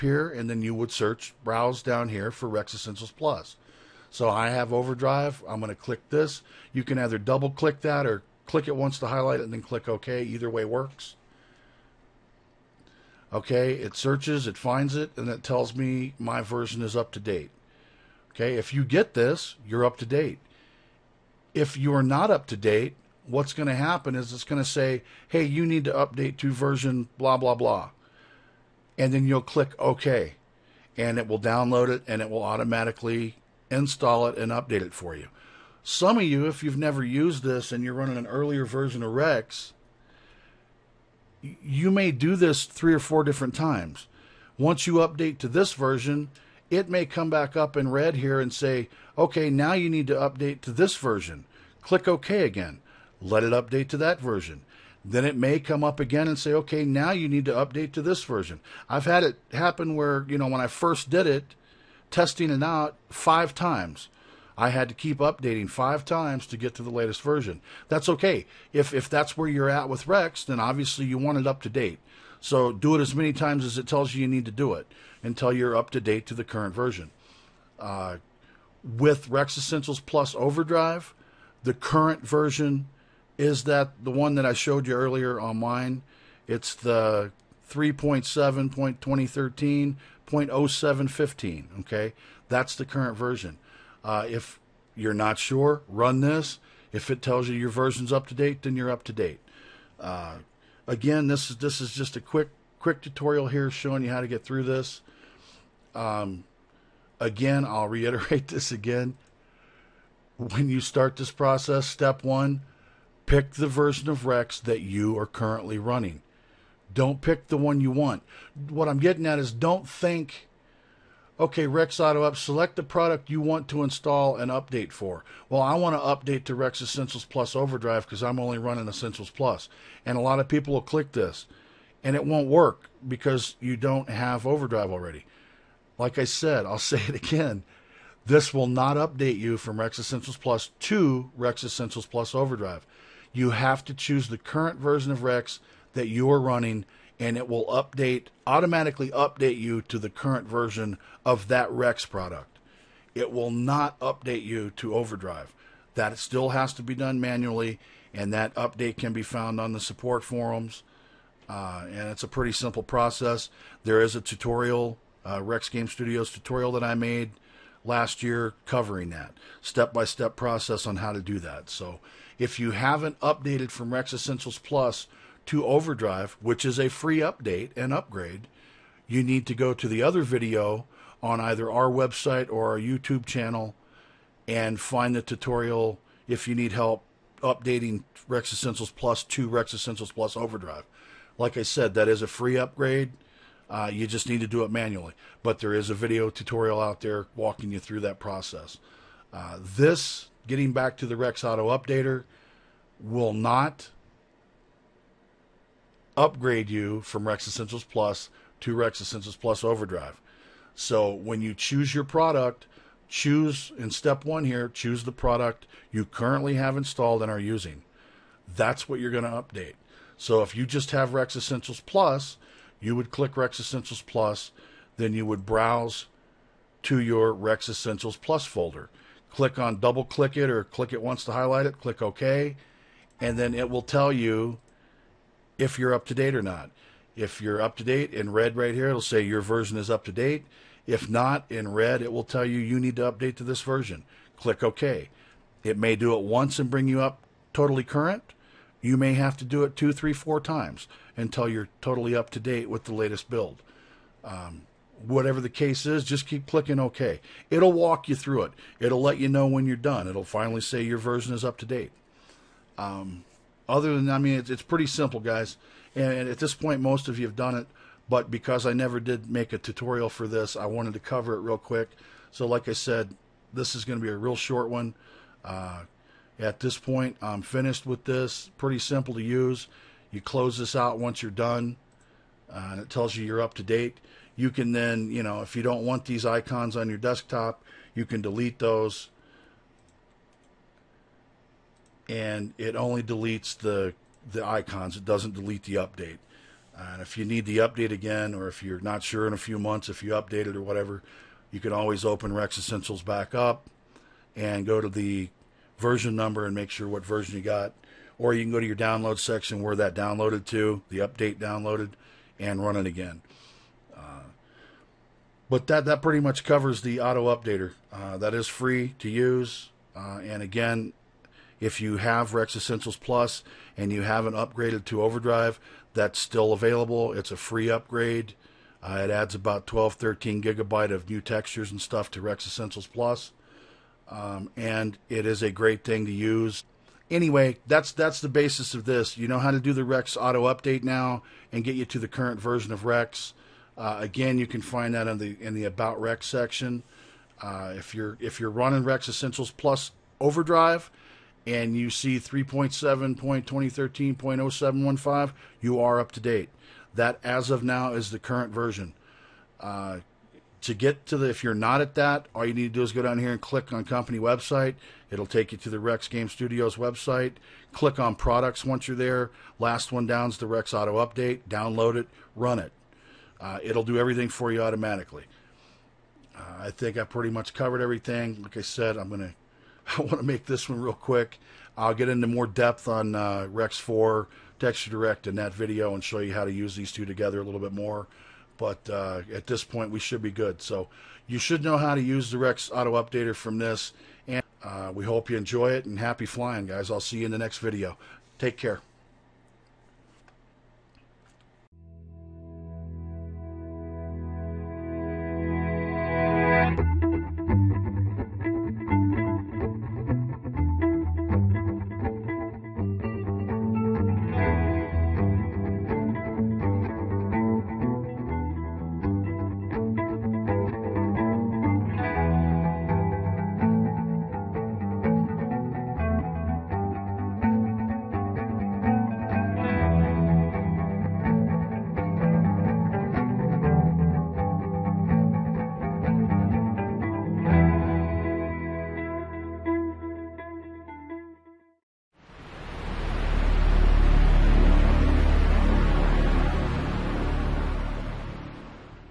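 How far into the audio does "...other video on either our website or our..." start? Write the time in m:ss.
3:00.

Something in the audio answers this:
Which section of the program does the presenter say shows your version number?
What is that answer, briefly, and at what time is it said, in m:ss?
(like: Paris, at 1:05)
About Rex, at 5:45.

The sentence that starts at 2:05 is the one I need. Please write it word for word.
Well, I want to update to Rex Essentials Plus Overdrive because I'm only running Essentials Plus.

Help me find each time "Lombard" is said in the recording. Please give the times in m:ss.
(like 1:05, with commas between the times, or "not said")
not said.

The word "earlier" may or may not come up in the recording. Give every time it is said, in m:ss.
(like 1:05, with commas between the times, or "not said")
0:38, 1:24.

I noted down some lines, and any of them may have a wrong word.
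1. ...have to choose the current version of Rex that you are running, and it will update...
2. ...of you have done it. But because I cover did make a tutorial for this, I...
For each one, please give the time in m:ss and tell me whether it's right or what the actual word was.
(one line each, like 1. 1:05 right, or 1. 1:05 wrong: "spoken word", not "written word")
1. 2:23 right
2. 4:27 wrong: "never", not "cover".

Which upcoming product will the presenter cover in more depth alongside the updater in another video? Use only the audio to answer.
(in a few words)
Rex 4 Texture Direct.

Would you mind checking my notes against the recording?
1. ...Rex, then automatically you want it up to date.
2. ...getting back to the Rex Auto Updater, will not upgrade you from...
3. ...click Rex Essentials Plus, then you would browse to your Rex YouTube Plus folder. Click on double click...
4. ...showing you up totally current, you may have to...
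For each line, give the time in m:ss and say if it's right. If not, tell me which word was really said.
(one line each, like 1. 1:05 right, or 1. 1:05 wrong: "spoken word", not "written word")
1. 1:10 wrong: "obviously", not "automatically"
2. 3:20 right
3. 3:43 wrong: "Essentials", not "YouTube"
4. 4:06 wrong: "bring", not "showing".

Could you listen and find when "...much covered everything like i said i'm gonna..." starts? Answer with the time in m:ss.
6:17.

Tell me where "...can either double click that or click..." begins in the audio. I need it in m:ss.
0:06.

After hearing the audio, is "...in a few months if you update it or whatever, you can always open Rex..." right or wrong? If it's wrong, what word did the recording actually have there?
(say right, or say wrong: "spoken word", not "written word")
right.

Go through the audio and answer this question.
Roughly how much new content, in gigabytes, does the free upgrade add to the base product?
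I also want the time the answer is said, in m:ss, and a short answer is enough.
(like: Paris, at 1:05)
12 to 13 GB, at 5:29.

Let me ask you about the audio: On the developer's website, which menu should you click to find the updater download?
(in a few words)
Products.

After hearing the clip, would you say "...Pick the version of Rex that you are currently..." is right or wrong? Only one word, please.
right.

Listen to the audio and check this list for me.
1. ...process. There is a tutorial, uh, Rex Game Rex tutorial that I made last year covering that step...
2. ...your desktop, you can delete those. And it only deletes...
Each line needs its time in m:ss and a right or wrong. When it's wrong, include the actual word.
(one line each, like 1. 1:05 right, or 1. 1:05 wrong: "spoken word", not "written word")
1. 2:42 wrong: "Studios", not "Rex"
2. 4:46 right.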